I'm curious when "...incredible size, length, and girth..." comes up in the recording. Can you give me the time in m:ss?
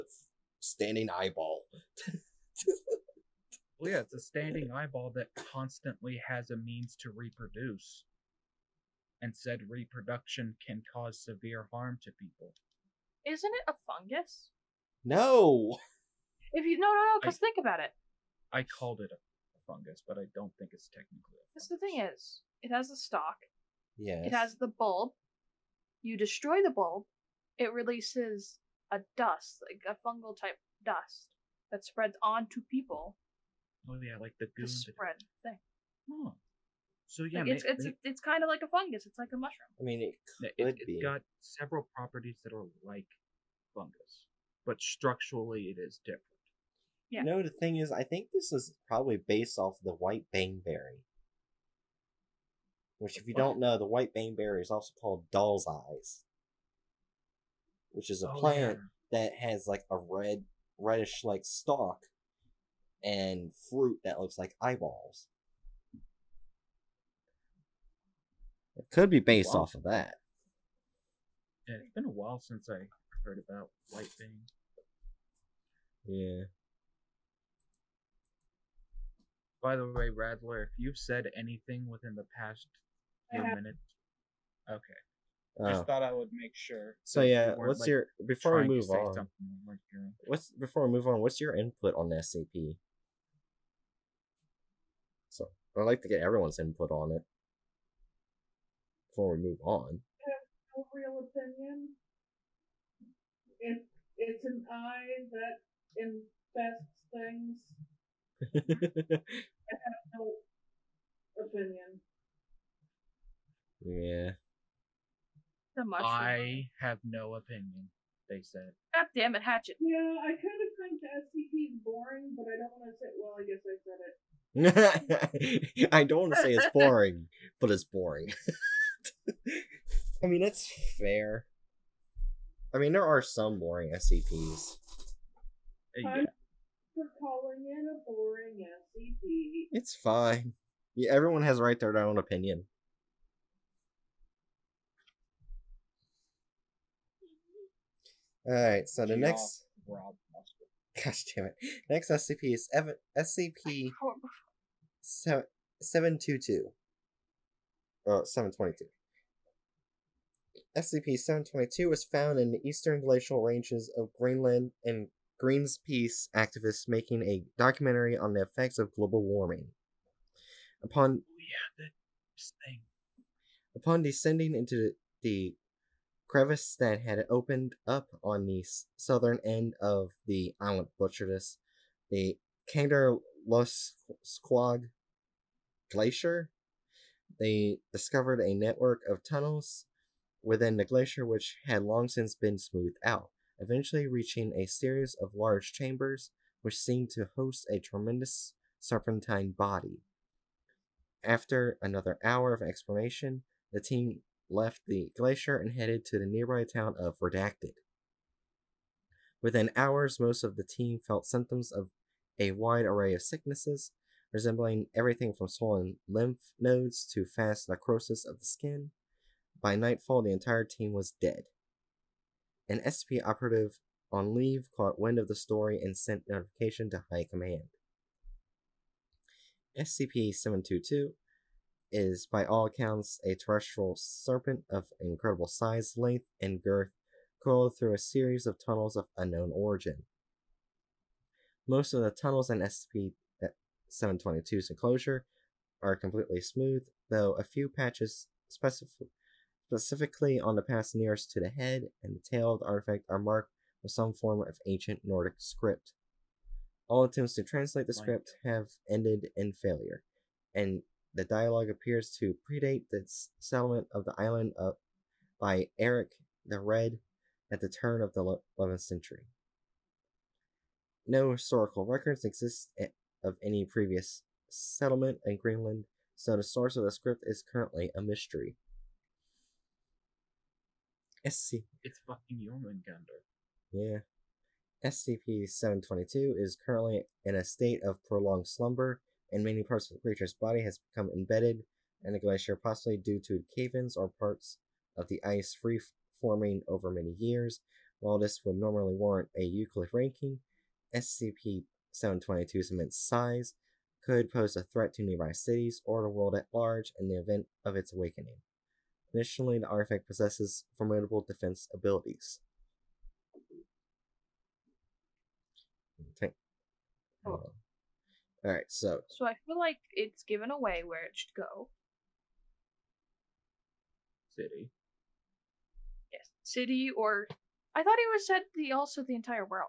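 3:54.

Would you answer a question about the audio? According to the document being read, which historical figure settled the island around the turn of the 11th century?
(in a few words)
Eric the Red.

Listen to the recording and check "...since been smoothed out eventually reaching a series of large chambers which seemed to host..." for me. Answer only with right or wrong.
right.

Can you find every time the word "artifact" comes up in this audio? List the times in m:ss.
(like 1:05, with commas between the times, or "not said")
4:12, 5:09.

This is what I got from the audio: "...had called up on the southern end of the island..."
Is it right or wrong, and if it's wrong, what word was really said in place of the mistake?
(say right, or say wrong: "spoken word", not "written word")
wrong: "opened", not "called".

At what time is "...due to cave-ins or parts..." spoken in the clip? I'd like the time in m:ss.
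4:52.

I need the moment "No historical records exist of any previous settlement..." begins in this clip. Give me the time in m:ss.
4:31.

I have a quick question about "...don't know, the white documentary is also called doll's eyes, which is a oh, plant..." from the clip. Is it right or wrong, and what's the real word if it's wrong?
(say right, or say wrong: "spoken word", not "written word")
wrong: "baneberry", not "documentary".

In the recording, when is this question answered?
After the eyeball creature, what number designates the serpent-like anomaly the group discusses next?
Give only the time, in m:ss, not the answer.
2:35.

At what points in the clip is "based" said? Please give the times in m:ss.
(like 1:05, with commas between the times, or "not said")
0:49, 1:09.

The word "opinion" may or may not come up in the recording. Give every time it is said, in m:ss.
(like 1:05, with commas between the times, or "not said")
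1:41, 1:51, 1:57, 2:22.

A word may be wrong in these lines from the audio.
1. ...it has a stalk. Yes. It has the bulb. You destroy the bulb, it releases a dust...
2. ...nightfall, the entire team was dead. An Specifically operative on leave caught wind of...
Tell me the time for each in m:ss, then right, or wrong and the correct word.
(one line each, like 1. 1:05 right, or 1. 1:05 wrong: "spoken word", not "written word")
1. 0:22 right
2. 3:39 wrong: "SCP", not "Specifically".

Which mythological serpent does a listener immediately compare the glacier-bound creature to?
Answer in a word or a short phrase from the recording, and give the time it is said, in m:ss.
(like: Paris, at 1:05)
Jormungandr, at 4:42.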